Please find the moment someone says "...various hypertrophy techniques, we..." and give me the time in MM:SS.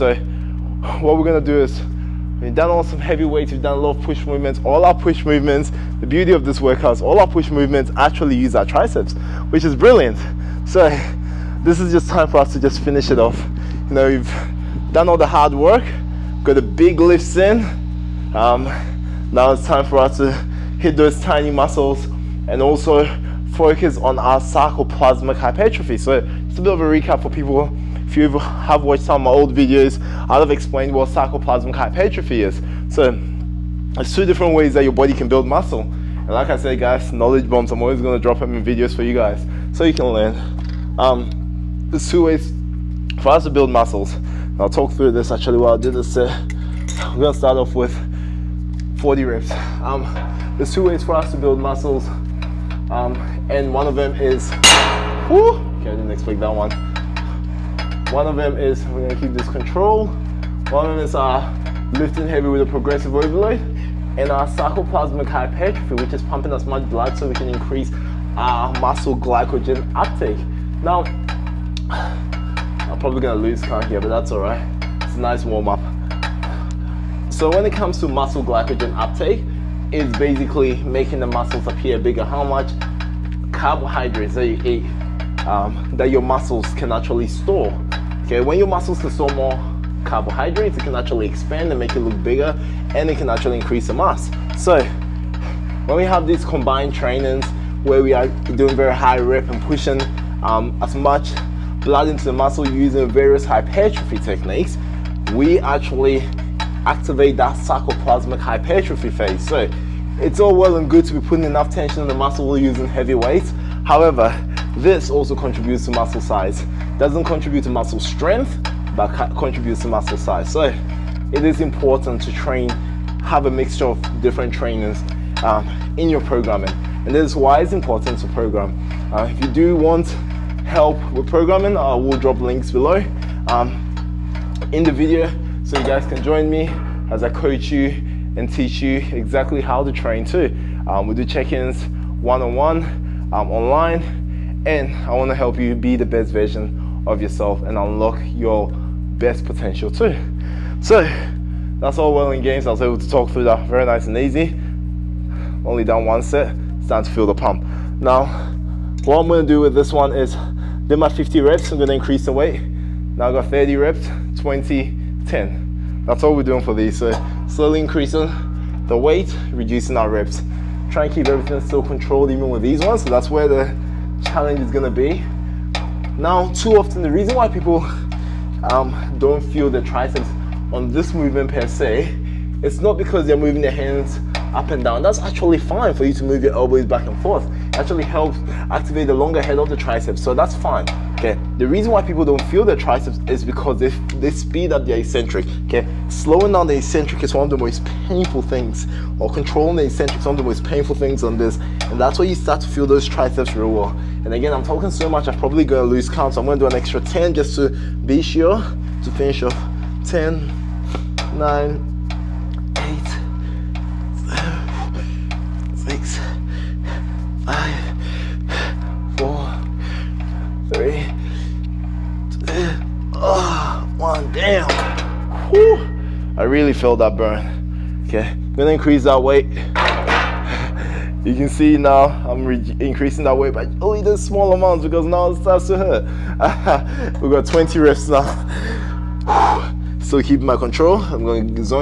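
01:43.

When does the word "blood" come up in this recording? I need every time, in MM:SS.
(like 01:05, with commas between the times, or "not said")
01:06, 01:41.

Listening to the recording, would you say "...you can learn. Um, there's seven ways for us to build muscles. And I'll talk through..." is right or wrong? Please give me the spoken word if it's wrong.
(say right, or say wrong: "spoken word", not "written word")
wrong: "two", not "seven".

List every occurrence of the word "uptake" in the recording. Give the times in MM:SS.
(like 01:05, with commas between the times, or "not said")
01:09, 01:18.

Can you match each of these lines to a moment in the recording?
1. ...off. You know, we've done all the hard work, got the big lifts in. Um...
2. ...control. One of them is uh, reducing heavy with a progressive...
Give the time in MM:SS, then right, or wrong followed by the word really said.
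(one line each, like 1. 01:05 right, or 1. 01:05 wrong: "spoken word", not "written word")
1. 00:13 right
2. 00:59 wrong: "lifting", not "reducing".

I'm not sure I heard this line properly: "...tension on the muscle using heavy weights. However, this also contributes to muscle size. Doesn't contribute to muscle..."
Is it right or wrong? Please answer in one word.
right.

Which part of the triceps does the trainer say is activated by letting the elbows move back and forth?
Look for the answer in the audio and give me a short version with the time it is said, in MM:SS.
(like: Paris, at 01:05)
Longer head, at 03:09.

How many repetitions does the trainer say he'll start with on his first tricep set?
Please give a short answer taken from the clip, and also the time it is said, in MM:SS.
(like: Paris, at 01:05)
40, at 00:48.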